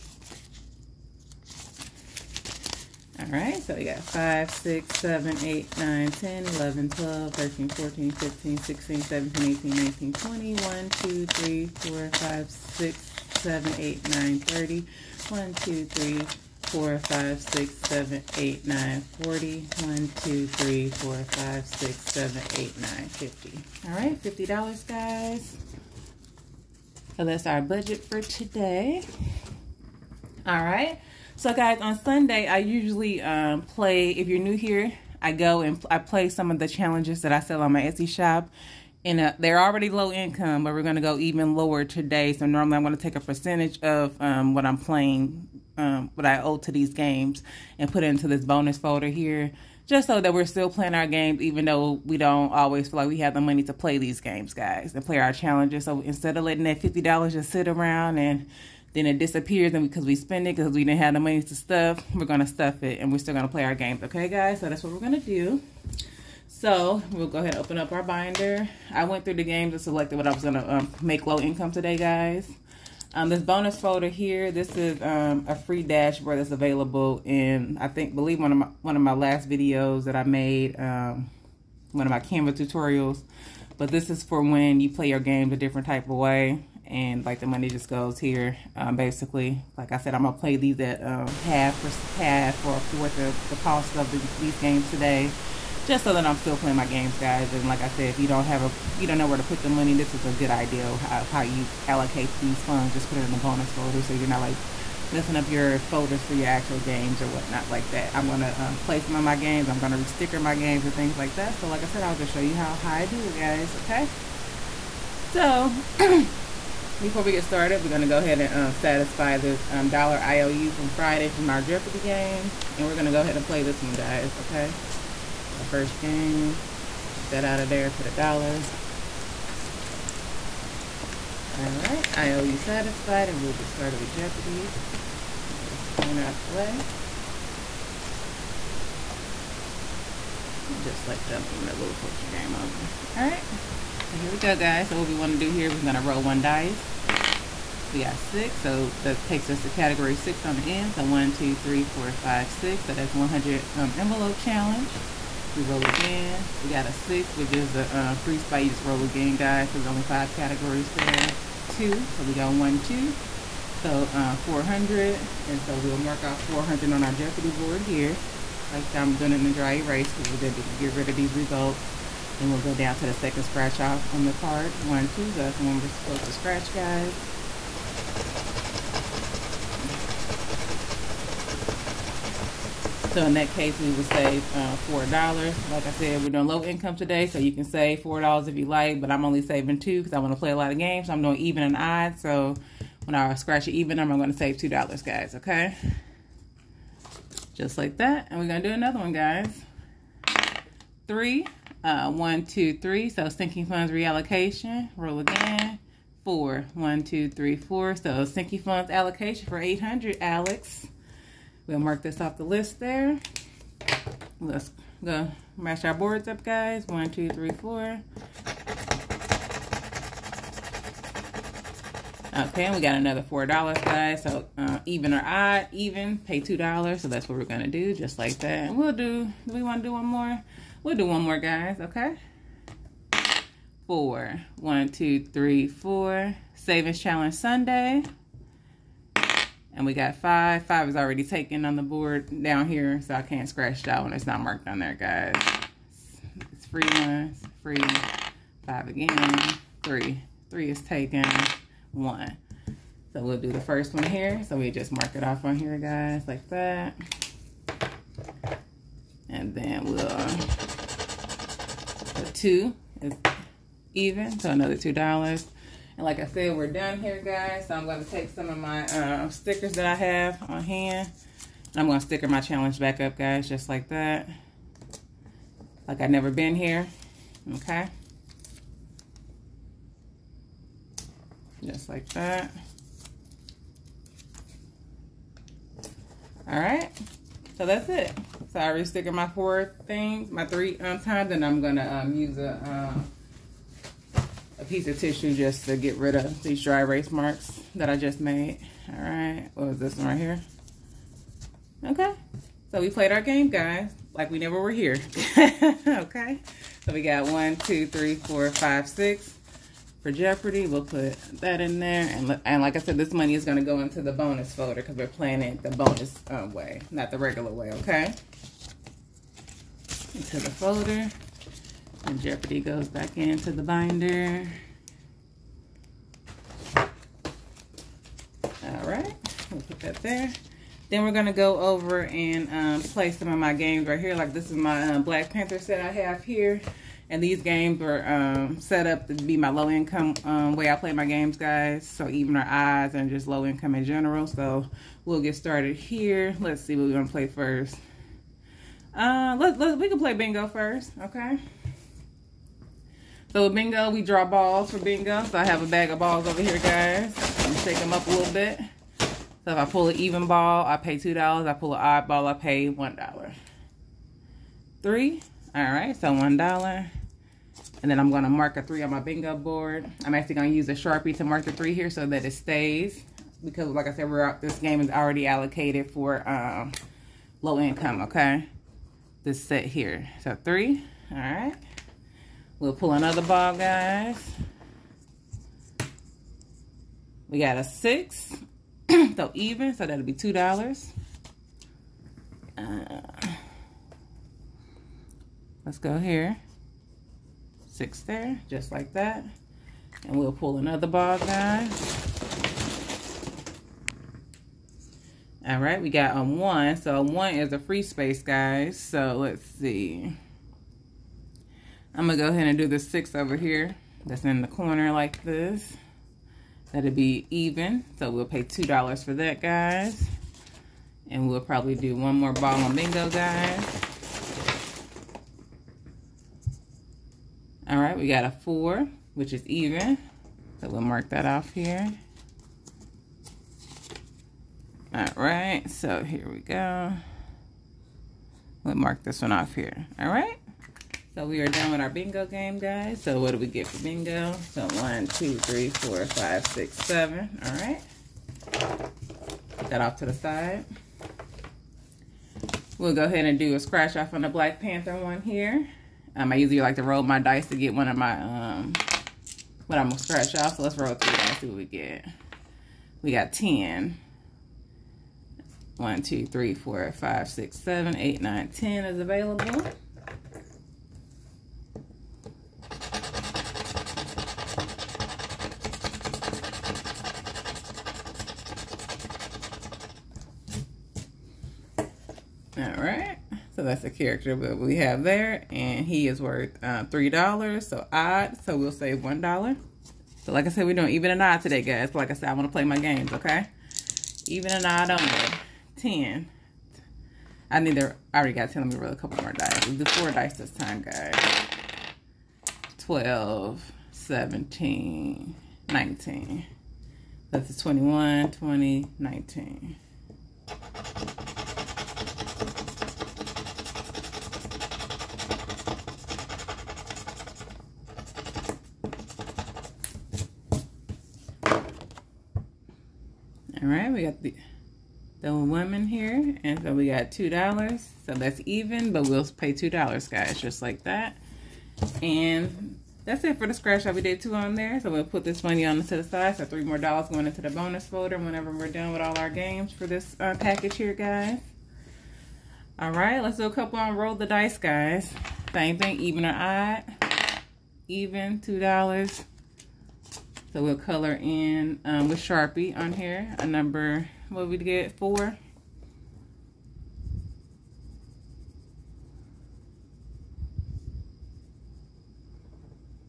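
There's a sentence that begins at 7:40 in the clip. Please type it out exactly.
So let's roll three and see what we get.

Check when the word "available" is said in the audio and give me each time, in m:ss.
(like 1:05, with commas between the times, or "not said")
1:16, 7:48.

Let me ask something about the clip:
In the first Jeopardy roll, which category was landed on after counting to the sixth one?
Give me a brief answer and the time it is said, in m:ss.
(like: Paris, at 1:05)
100 envelope challenge, at 2:33.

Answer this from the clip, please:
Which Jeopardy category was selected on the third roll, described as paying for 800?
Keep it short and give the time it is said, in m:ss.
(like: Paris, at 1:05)
sinking funds reallocation, at 3:23.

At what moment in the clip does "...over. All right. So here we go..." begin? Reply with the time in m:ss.
2:22.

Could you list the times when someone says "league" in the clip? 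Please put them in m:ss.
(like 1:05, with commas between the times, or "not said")
not said.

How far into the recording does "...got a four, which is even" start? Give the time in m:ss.
7:08.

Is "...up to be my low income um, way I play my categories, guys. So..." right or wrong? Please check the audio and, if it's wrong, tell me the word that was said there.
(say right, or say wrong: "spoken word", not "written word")
wrong: "games", not "categories".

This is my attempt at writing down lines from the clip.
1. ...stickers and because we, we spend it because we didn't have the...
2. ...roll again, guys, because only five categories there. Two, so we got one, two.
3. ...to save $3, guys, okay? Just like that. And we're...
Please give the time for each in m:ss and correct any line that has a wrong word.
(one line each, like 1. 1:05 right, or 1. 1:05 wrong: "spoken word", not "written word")
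1. 0:59 wrong: "disappears", not "stickers"
2. 2:38 right
3. 3:14 wrong: "2", not "3".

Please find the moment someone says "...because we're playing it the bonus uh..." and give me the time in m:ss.
5:14.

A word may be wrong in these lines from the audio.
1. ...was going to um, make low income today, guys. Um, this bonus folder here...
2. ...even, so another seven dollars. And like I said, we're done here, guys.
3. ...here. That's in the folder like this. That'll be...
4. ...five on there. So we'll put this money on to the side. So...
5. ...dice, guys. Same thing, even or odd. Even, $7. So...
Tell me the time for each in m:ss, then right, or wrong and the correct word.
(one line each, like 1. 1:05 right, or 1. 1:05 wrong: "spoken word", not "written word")
1. 1:10 right
2. 4:23 wrong: "two", not "seven"
3. 6:53 wrong: "corner", not "folder"
4. 8:54 wrong: "two", not "five"
5. 9:04 wrong: "2", not "7".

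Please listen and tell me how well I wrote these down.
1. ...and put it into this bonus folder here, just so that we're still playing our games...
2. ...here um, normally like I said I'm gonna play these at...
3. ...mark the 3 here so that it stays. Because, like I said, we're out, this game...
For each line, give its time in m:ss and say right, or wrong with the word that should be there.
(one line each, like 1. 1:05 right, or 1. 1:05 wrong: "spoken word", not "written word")
1. 0:47 right
2. 1:28 wrong: "basically", not "normally"
3. 6:11 right.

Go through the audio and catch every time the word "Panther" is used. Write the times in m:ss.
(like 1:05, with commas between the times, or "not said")
5:35, 7:34.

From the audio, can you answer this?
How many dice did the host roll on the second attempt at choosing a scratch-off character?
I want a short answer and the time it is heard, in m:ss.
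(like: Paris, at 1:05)
4, at 8:19.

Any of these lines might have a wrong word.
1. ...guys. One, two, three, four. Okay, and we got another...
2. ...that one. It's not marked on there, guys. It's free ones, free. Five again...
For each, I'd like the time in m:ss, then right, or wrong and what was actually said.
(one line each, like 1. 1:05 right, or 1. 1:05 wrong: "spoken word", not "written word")
1. 3:36 right
2. 4:03 right.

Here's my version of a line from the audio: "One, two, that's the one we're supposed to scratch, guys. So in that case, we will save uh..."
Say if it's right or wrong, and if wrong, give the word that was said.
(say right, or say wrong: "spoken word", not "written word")
right.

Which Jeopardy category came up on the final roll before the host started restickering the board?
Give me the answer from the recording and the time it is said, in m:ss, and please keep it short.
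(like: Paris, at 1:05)
Savings Challenge Sunday, at 3:56.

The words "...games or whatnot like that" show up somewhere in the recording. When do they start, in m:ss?
1:46.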